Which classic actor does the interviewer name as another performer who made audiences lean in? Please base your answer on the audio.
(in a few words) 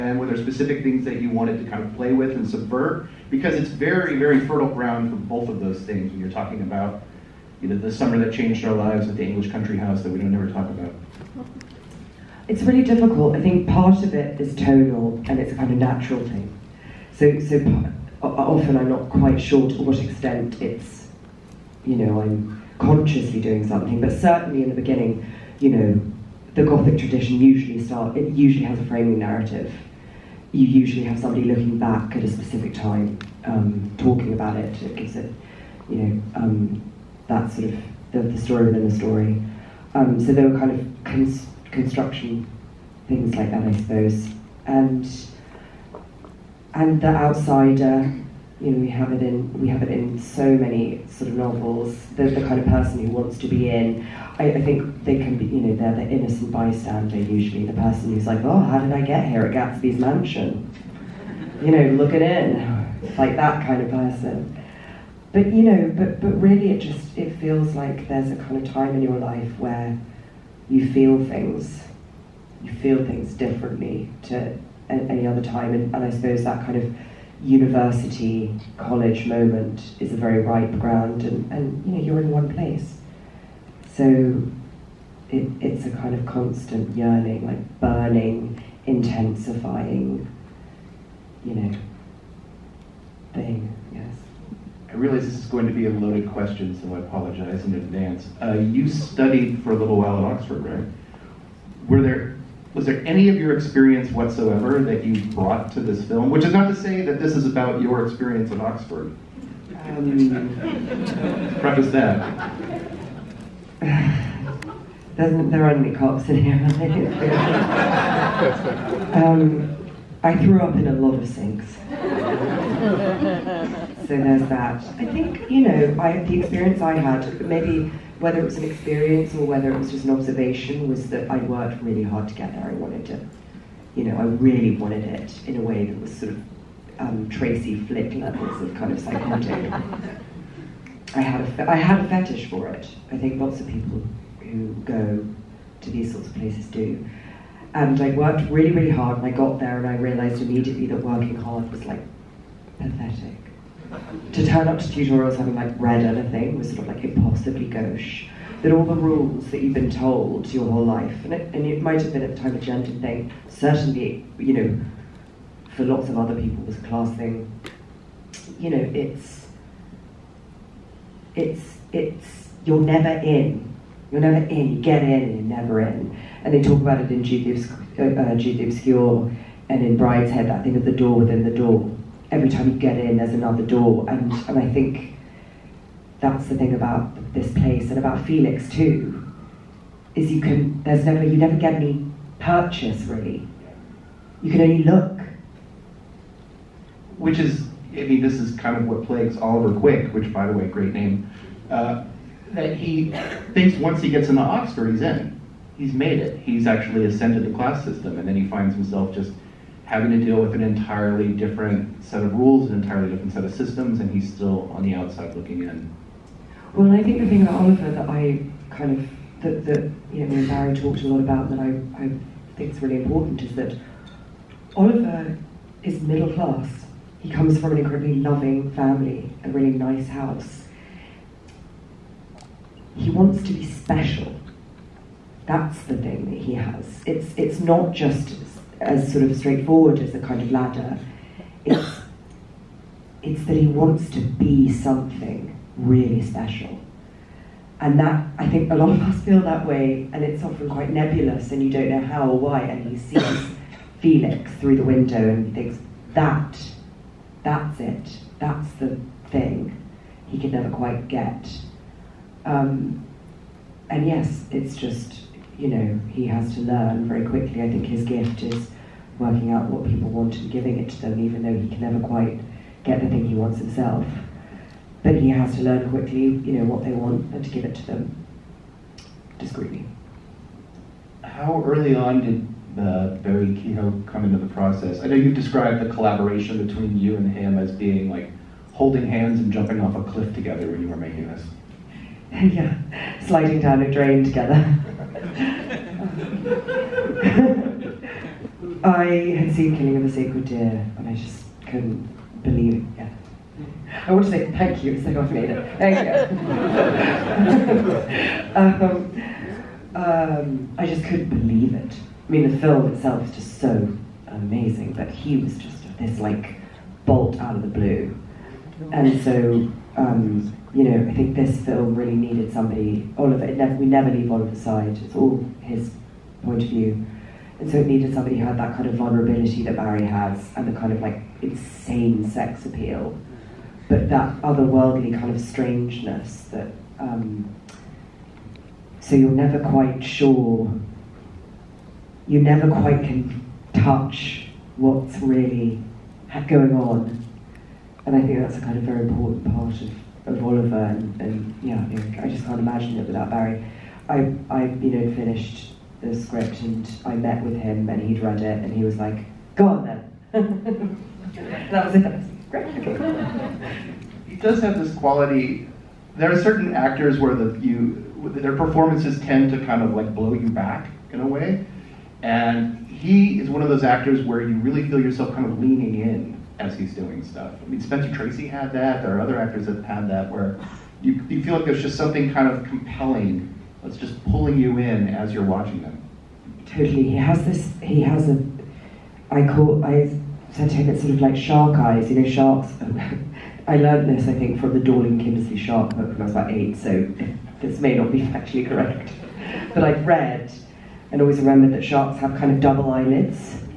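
Spencer Tracy.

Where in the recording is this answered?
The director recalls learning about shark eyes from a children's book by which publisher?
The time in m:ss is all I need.
6:34.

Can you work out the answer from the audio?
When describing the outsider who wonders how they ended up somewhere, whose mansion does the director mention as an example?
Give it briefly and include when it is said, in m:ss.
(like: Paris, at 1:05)
Gatsby's, at 0:59.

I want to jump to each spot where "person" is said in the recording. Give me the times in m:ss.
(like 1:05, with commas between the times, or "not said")
0:52, 0:57, 1:03.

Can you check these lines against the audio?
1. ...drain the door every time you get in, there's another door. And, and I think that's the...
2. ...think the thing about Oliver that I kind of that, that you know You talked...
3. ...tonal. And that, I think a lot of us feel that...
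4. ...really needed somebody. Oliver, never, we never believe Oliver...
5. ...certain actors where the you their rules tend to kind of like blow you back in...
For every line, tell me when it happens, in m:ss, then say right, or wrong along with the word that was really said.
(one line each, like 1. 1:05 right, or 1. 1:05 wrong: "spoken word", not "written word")
1. 3:01 wrong: "within", not "drain"
2. 3:37 wrong: "Barry", not "You"
3. 4:06 wrong: "special", not "tonal"
4. 5:21 wrong: "leave", not "believe"
5. 6:06 wrong: "performances", not "rules".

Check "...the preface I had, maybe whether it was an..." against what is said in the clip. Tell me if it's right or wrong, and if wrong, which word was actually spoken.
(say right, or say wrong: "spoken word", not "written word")
wrong: "experience", not "preface".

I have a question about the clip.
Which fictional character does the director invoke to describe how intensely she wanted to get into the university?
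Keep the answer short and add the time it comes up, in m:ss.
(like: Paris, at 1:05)
Tracy Flick, at 2:17.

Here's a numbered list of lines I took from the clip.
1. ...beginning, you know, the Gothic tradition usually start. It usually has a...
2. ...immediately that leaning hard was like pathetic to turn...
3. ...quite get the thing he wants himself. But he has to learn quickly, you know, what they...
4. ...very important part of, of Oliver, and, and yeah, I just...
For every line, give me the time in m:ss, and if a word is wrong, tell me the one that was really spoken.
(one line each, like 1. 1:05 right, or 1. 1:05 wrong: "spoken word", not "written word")
1. 0:24 right
2. 2:30 wrong: "working", not "leaning"
3. 4:32 right
4. 5:48 right.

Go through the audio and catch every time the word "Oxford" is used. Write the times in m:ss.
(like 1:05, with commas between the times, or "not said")
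1:40, 1:48, 3:24.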